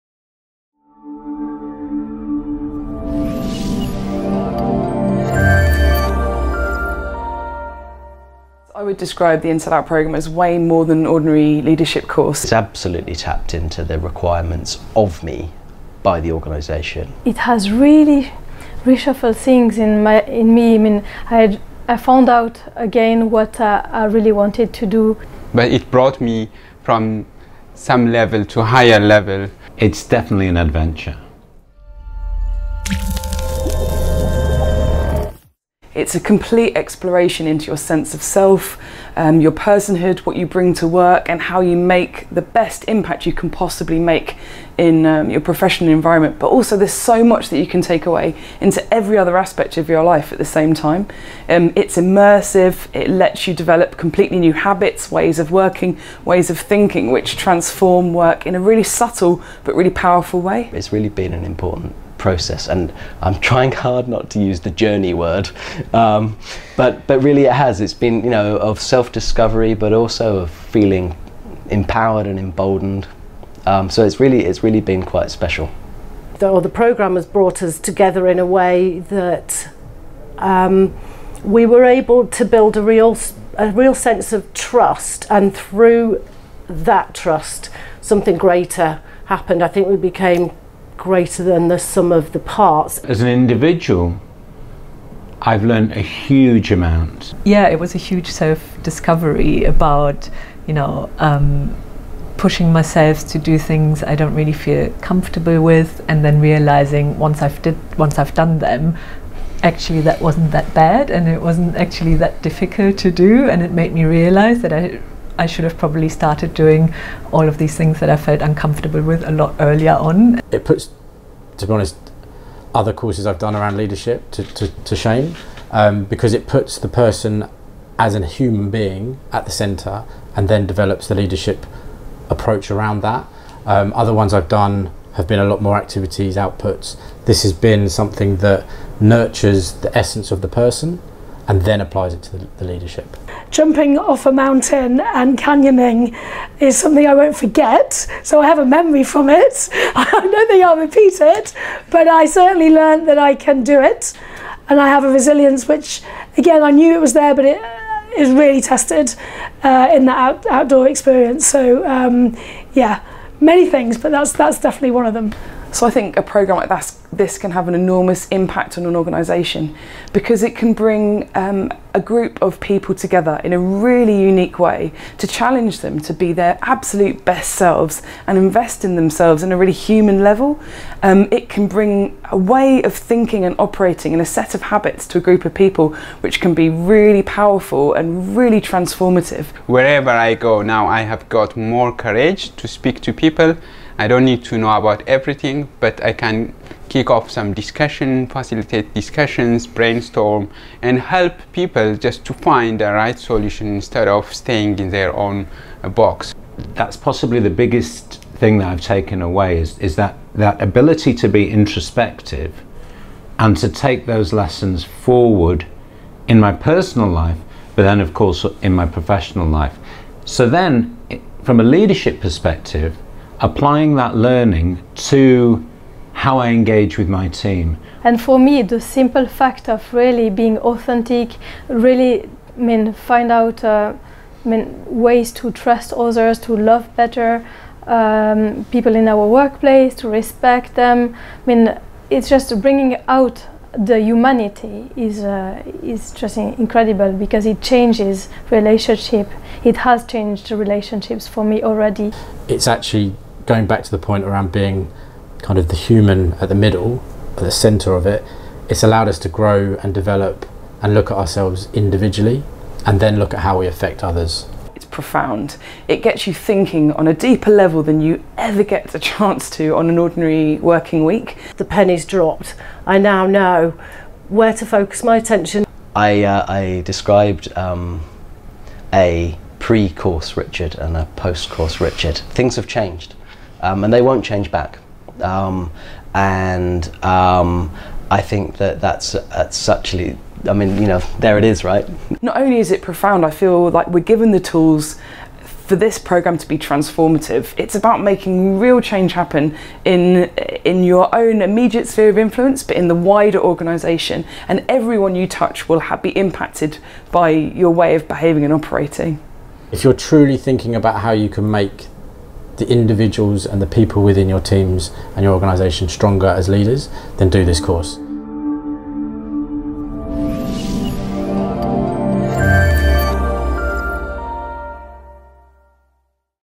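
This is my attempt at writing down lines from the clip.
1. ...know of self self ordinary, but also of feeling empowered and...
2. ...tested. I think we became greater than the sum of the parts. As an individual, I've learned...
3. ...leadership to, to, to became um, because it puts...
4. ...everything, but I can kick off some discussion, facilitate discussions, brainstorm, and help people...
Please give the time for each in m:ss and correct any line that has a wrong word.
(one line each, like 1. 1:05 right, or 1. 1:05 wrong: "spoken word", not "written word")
1. 1:08 wrong: "discovery", not "ordinary"
2. 1:29 wrong: "happened", not "tested"
3. 2:03 wrong: "shame", not "became"
4. 3:15 right.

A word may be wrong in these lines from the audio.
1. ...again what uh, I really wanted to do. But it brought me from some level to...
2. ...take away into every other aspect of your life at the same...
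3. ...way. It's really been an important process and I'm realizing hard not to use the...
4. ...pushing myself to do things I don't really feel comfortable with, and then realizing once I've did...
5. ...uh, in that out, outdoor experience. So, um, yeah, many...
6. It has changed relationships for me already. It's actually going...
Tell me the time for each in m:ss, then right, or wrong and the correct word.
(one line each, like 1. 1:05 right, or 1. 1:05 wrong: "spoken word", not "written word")
1. 0:22 right
2. 0:47 right
3. 1:00 wrong: "trying", not "realizing"
4. 1:42 right
5. 2:39 right
6. 4:09 right.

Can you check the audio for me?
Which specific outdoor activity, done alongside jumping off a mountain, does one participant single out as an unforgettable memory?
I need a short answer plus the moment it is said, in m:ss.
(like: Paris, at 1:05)
Canyoning, at 2:25.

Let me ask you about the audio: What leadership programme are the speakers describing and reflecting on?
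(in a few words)
InsideOut.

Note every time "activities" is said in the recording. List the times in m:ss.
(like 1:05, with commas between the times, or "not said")
2:15.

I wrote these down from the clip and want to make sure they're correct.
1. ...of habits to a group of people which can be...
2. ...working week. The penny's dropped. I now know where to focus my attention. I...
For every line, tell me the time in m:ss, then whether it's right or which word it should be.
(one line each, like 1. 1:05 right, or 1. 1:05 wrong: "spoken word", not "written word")
1. 3:04 right
2. 4:30 right.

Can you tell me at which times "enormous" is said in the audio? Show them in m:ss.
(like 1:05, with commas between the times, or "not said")
2:47.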